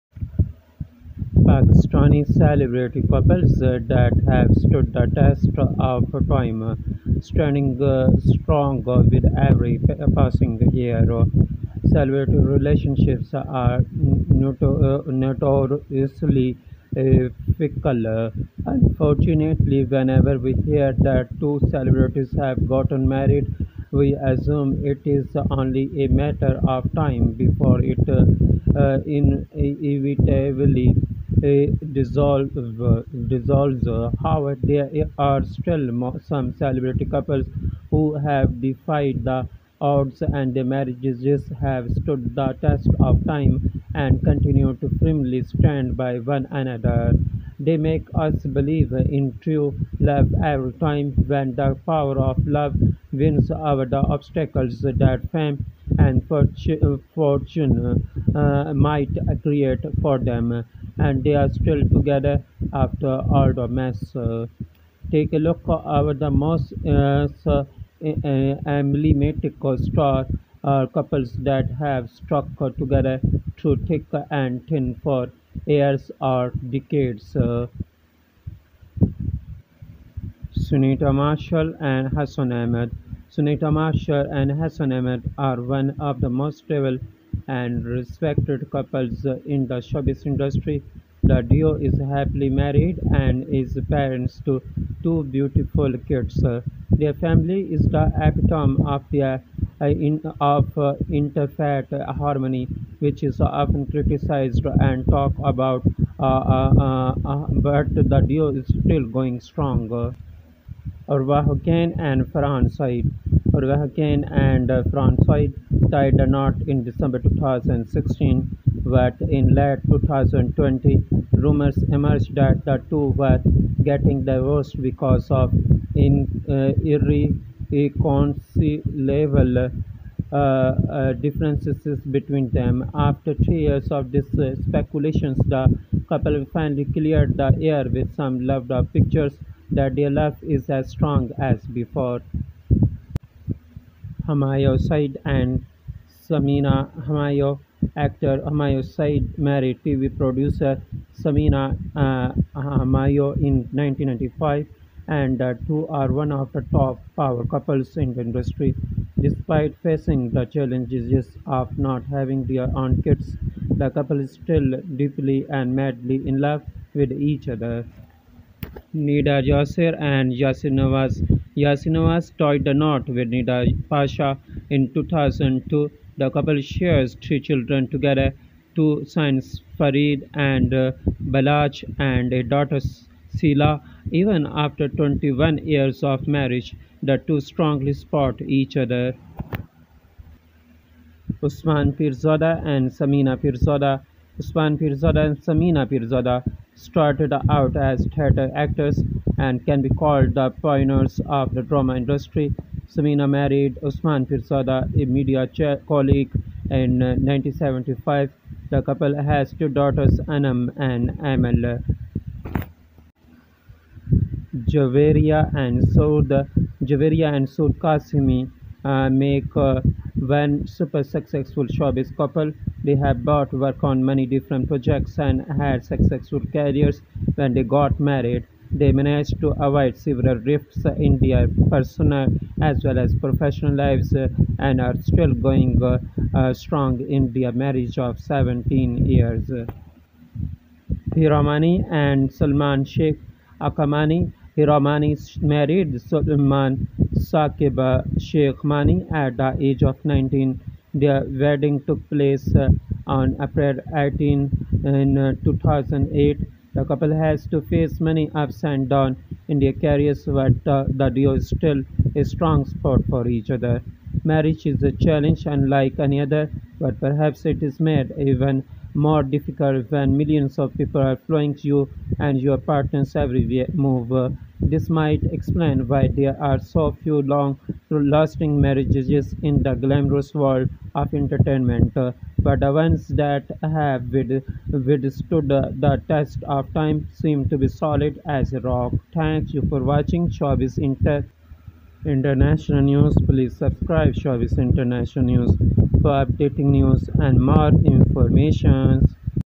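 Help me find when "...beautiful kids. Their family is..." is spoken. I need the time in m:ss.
1:35.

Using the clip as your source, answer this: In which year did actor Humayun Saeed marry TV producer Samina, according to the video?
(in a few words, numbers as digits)
1995.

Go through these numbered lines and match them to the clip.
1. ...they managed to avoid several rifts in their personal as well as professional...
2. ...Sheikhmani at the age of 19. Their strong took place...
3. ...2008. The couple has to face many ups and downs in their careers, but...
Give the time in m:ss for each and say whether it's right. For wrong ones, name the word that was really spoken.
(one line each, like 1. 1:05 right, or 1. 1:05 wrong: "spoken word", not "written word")
1. 3:48 right
2. 4:08 wrong: "wedding", not "strong"
3. 4:15 right.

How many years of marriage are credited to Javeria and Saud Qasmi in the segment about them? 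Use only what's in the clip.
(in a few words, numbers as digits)
17.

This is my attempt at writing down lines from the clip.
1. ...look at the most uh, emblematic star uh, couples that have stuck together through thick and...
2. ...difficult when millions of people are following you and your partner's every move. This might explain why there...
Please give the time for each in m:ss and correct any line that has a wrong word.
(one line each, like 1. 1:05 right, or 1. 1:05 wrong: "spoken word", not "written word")
1. 1:05 right
2. 4:29 right.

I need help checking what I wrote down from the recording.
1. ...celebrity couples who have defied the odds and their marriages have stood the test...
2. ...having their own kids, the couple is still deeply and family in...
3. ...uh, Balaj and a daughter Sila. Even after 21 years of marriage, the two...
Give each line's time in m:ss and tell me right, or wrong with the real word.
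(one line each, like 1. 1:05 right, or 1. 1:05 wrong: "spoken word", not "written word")
1. 0:36 right
2. 2:42 wrong: "madly", not "family"
3. 3:00 right.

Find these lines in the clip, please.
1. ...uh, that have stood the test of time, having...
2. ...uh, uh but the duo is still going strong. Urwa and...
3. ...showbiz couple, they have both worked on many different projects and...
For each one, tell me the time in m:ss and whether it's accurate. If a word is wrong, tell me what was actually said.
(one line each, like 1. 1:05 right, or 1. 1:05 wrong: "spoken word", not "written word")
1. 0:03 wrong: "standing", not "having"
2. 1:46 right
3. 3:41 right.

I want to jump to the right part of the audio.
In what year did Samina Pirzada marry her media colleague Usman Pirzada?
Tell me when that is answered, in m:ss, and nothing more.
3:26.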